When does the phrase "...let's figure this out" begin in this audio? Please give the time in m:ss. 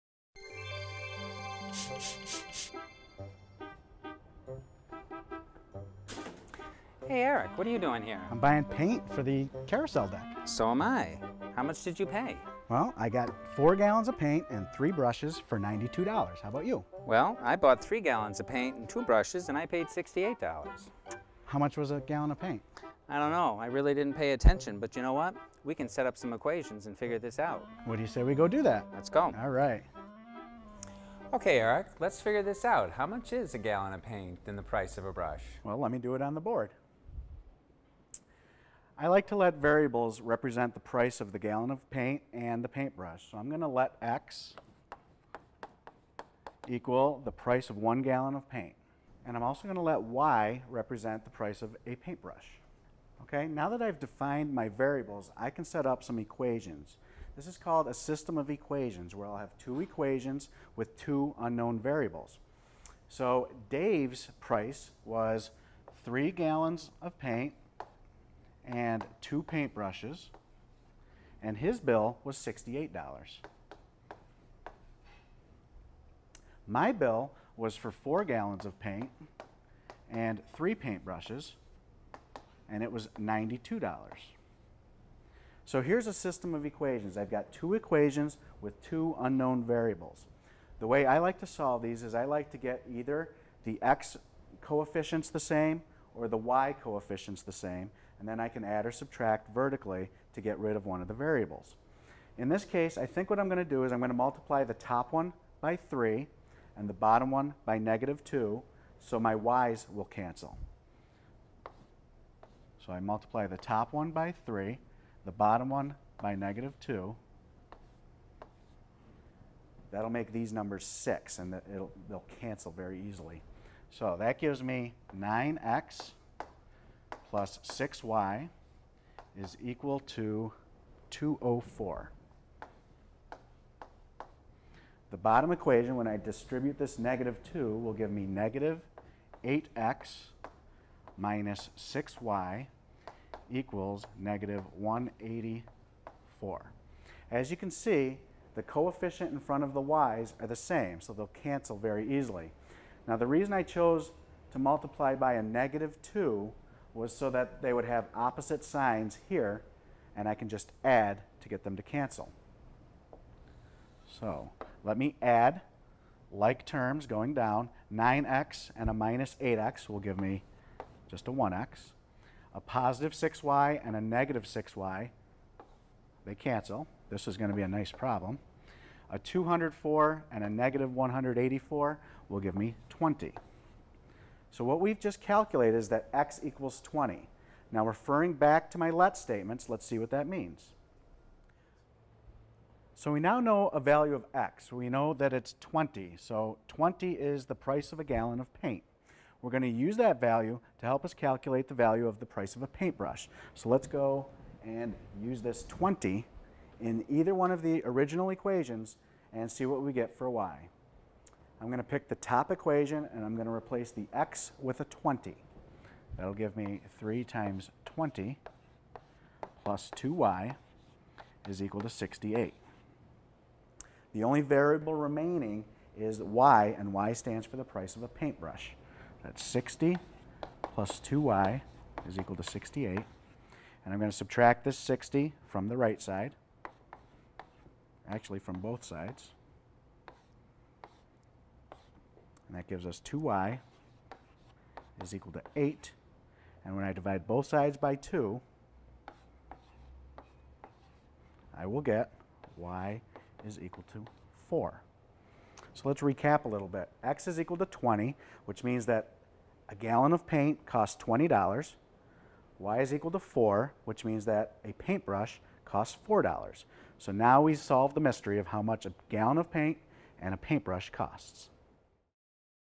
0:32.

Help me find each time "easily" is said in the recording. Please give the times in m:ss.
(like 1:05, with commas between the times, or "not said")
2:03, 2:32.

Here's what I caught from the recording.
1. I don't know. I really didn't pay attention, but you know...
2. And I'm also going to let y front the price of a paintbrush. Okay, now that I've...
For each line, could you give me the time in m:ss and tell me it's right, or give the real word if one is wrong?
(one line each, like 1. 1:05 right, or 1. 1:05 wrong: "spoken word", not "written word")
1. 0:23 right
2. 0:49 wrong: "represent", not "front".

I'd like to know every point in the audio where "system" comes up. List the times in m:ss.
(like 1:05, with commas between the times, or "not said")
0:57, 1:26.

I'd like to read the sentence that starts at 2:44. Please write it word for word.
So let me add like terms going down.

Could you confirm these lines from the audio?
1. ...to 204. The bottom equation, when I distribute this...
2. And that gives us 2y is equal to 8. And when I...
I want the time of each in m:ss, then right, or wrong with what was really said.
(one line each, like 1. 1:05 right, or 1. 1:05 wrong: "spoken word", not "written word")
1. 2:09 right
2. 4:02 right.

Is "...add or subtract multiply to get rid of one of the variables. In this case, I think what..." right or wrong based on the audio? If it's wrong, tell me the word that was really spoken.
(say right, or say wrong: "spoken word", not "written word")
wrong: "vertically", not "multiply".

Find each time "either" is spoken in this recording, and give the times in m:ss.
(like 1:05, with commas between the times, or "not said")
1:32, 3:27.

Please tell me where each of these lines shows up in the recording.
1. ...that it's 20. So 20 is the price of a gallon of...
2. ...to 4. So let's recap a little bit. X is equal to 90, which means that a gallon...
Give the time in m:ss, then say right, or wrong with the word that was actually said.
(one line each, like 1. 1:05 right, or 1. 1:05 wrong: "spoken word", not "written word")
1. 3:15 right
2. 4:13 wrong: "20", not "90".